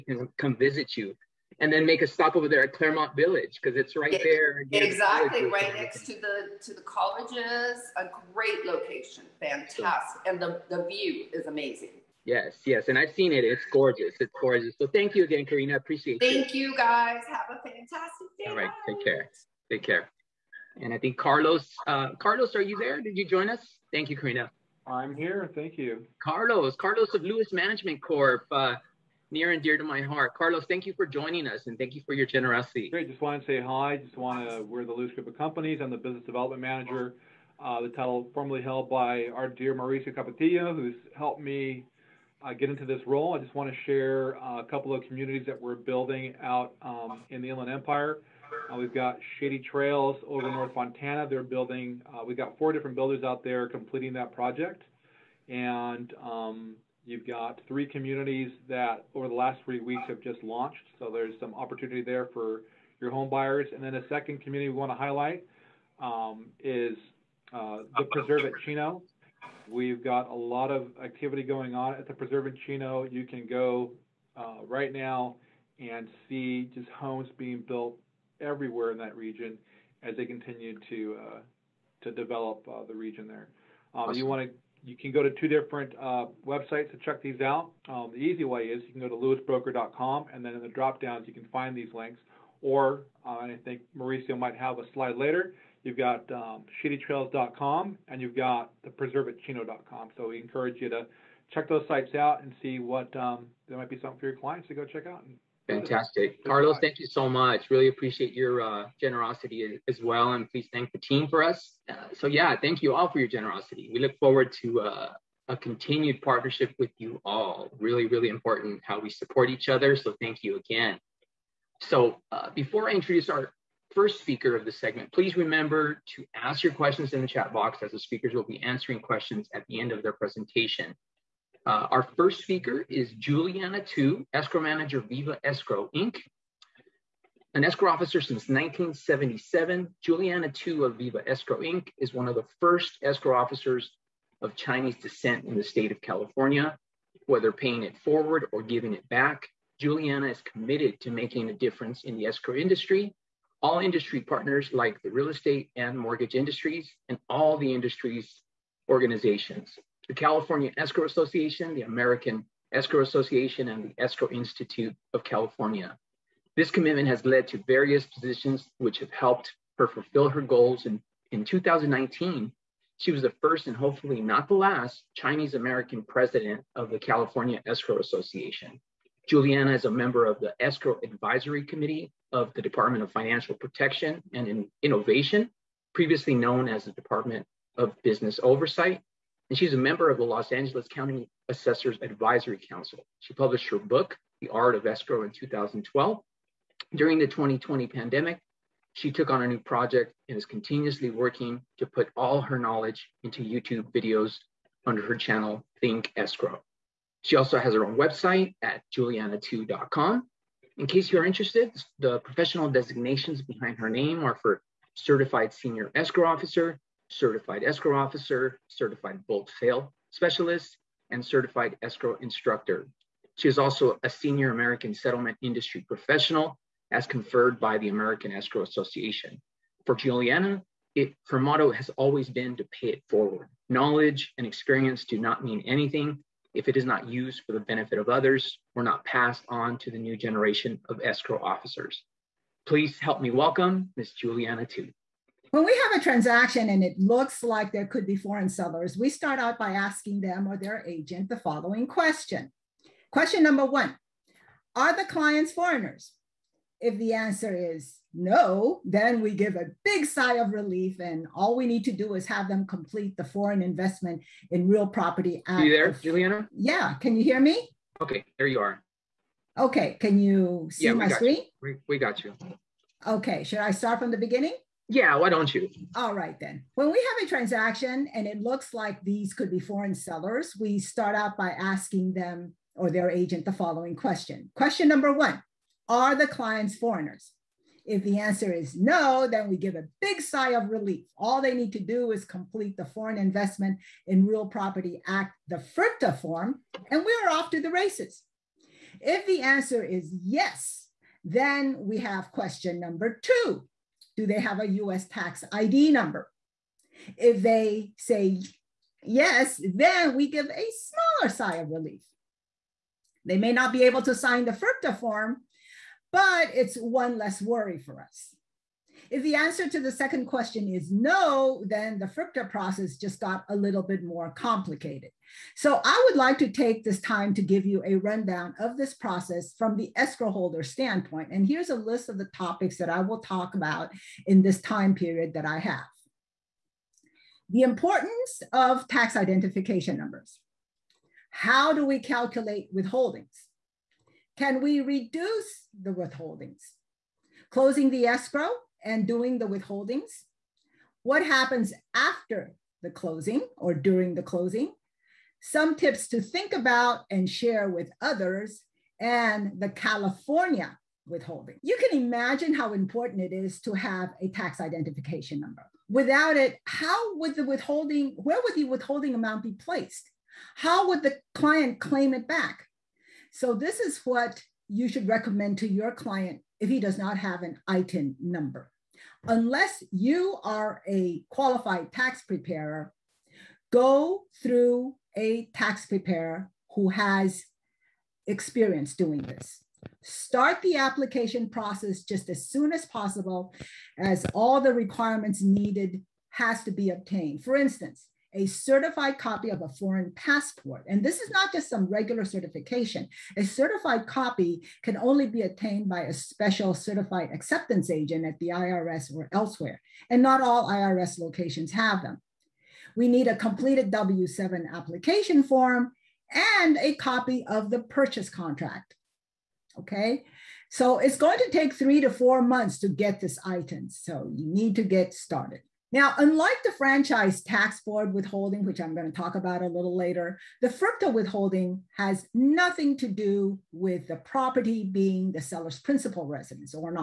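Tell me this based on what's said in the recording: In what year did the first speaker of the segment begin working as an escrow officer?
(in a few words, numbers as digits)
1977.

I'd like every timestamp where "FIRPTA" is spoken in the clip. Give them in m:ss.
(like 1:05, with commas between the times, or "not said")
4:55, 5:14, 5:22, 7:10.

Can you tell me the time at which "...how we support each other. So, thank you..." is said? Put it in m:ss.
1:58.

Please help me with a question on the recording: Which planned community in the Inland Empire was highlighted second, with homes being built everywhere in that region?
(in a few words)
the Preserve at Chino.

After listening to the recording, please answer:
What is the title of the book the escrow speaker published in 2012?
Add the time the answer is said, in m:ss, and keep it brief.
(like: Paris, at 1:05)
The Art of Escrow, at 3:14.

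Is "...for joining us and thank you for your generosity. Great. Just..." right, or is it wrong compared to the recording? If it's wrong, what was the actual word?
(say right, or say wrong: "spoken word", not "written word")
right.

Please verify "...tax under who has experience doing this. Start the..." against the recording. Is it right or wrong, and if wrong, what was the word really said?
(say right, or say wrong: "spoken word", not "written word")
wrong: "preparer", not "under".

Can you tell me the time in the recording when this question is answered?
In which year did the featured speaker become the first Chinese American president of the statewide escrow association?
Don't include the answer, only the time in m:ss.
2:51.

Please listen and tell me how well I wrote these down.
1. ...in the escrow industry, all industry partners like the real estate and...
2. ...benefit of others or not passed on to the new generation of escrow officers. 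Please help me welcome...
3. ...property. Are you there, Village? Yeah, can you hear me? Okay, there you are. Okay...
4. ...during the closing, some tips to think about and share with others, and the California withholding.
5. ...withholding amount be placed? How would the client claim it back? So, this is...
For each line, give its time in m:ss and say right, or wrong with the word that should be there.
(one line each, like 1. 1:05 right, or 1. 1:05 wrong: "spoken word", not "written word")
1. 2:32 right
2. 3:57 right
3. 4:24 wrong: "Juliana", not "Village"
4. 5:53 right
5. 6:08 right.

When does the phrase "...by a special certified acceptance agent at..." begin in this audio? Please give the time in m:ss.
6:45.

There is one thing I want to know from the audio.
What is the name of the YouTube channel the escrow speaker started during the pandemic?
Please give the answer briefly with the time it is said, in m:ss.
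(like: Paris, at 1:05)
Think Escrow, at 3:25.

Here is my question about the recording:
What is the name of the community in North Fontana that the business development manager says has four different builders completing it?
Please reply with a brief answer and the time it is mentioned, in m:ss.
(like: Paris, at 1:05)
Shady Trails, at 0:49.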